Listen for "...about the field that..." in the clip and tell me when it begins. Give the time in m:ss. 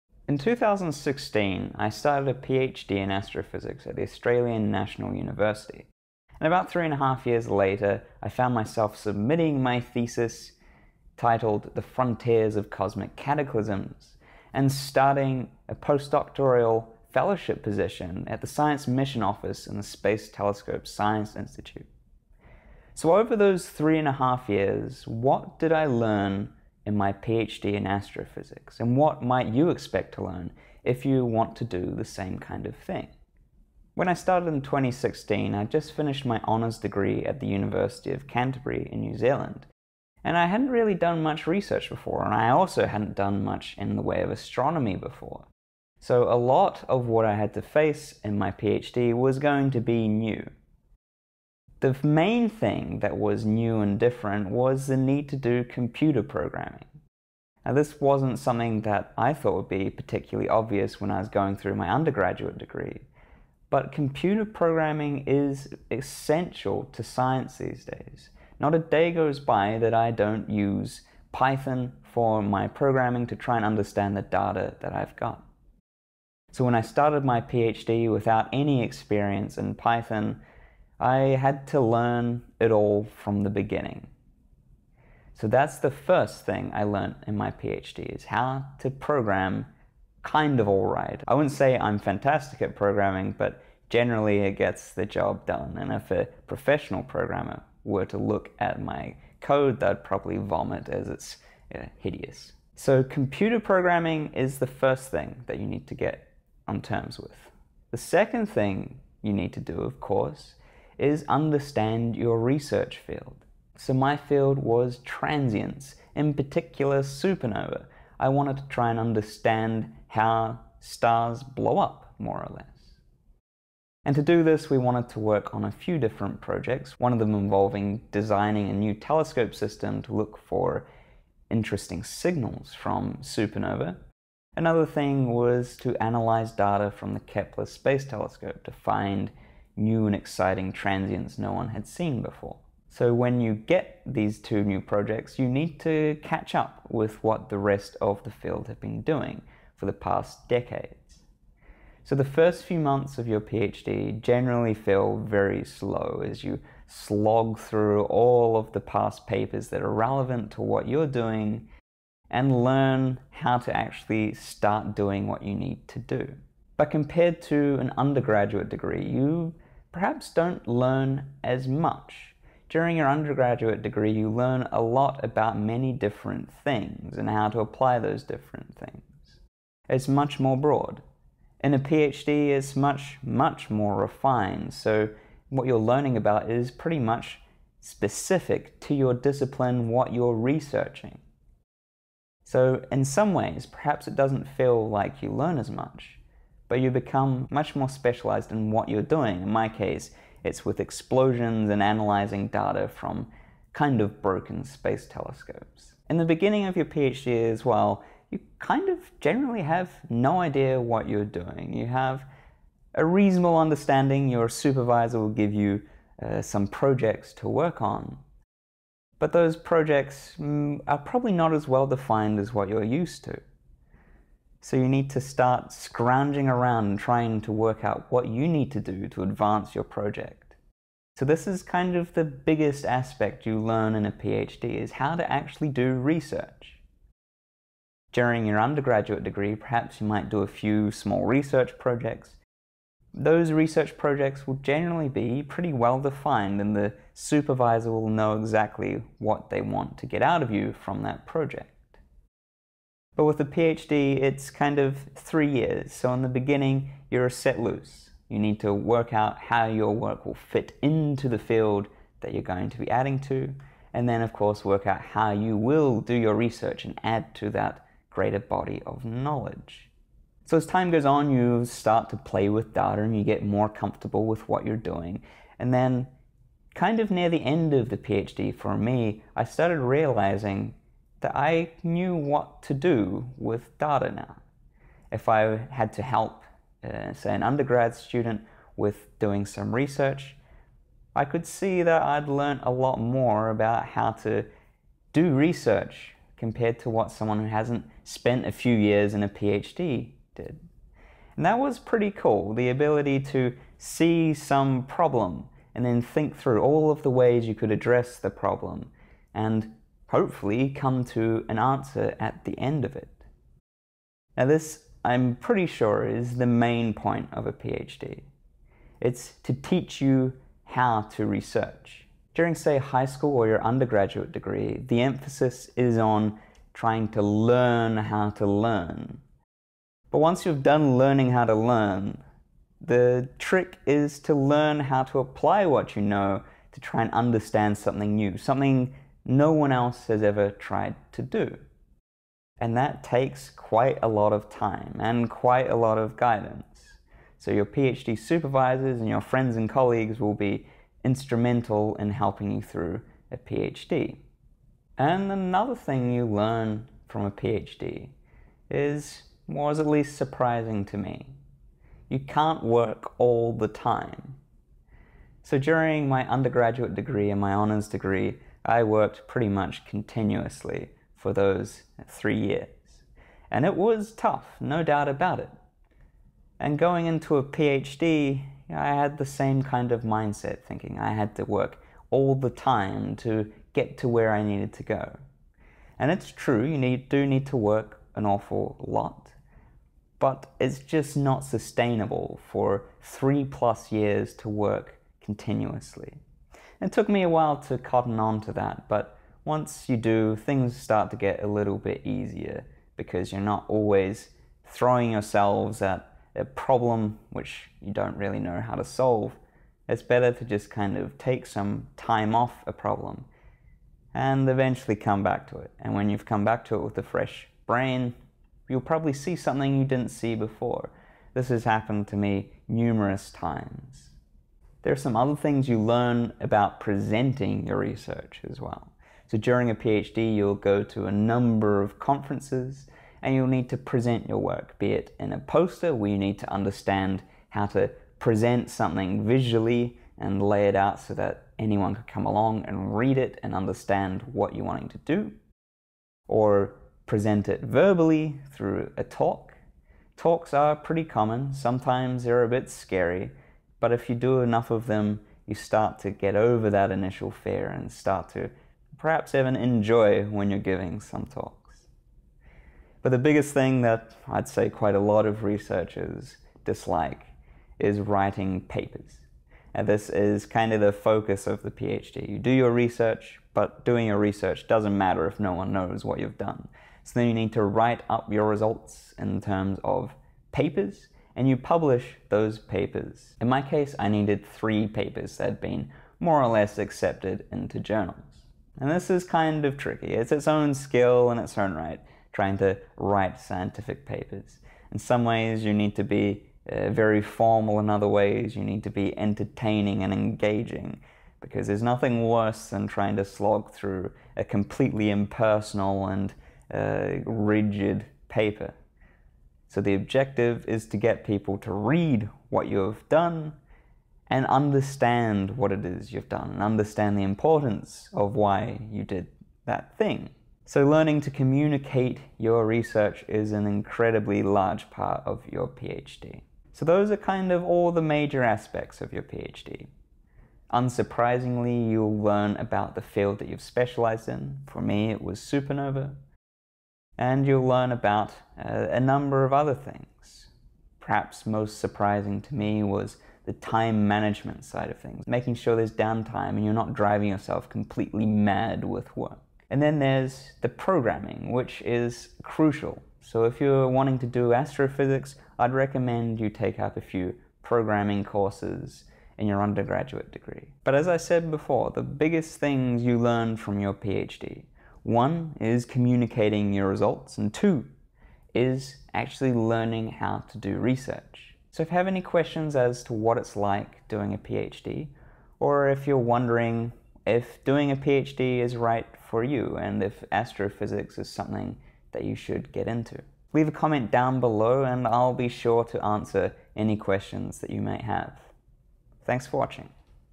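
8:52.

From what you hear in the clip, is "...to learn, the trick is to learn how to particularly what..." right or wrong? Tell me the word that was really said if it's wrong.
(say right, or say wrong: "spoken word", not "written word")
wrong: "apply", not "particularly".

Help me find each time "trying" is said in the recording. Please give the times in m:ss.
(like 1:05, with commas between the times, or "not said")
3:46, 5:26, 8:12, 8:22.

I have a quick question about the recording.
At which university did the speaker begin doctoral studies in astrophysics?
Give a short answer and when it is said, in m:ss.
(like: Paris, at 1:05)
Australian National University, at 0:04.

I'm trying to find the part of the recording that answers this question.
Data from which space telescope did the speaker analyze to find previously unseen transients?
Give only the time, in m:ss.
2:17.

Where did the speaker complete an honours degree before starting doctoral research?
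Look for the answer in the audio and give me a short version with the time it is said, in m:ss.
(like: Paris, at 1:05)
University of Canterbury, at 0:37.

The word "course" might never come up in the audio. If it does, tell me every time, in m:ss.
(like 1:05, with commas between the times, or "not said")
1:49, 4:24, 9:18.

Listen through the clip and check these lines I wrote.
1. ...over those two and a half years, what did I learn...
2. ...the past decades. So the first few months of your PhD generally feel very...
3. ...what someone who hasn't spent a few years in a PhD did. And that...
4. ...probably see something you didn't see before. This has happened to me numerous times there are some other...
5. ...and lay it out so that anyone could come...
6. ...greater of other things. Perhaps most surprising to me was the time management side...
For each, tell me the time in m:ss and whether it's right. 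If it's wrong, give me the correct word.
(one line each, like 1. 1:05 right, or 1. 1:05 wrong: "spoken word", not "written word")
1. 0:23 wrong: "three", not "two"
2. 2:29 right
3. 4:56 right
4. 6:58 right
5. 7:20 right
6. 8:58 wrong: "number", not "greater".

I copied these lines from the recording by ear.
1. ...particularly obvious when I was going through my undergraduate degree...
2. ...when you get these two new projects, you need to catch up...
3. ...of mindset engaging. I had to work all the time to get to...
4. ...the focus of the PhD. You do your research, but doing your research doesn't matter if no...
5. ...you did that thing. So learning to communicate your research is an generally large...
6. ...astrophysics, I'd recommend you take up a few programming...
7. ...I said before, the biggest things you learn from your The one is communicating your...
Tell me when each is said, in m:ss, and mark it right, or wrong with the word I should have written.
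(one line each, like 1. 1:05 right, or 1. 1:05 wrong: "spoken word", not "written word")
1. 0:59 right
2. 2:23 right
3. 6:19 wrong: "thinking", not "engaging"
4. 7:50 right
5. 8:38 wrong: "incredibly", not "generally"
6. 9:14 right
7. 9:21 wrong: "PhD", not "The".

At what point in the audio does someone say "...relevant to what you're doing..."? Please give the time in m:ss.
2:39.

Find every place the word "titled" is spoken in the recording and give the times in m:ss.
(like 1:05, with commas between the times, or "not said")
0:11.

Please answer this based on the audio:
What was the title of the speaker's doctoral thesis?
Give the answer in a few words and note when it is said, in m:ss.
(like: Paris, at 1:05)
The Frontiers of Cosmic Cataclysms, at 0:11.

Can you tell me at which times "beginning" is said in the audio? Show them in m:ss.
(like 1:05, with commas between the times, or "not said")
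1:23, 3:26, 4:16.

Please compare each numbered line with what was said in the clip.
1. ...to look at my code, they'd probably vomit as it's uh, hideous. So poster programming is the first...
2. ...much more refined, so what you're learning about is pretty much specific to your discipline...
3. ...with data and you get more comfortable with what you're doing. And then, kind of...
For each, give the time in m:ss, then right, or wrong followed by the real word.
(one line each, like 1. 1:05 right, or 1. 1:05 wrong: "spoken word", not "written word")
1. 1:38 wrong: "computer", not "poster"
2. 3:03 right
3. 4:32 right.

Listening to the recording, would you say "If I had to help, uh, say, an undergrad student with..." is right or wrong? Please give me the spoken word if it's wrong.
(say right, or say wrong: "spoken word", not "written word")
right.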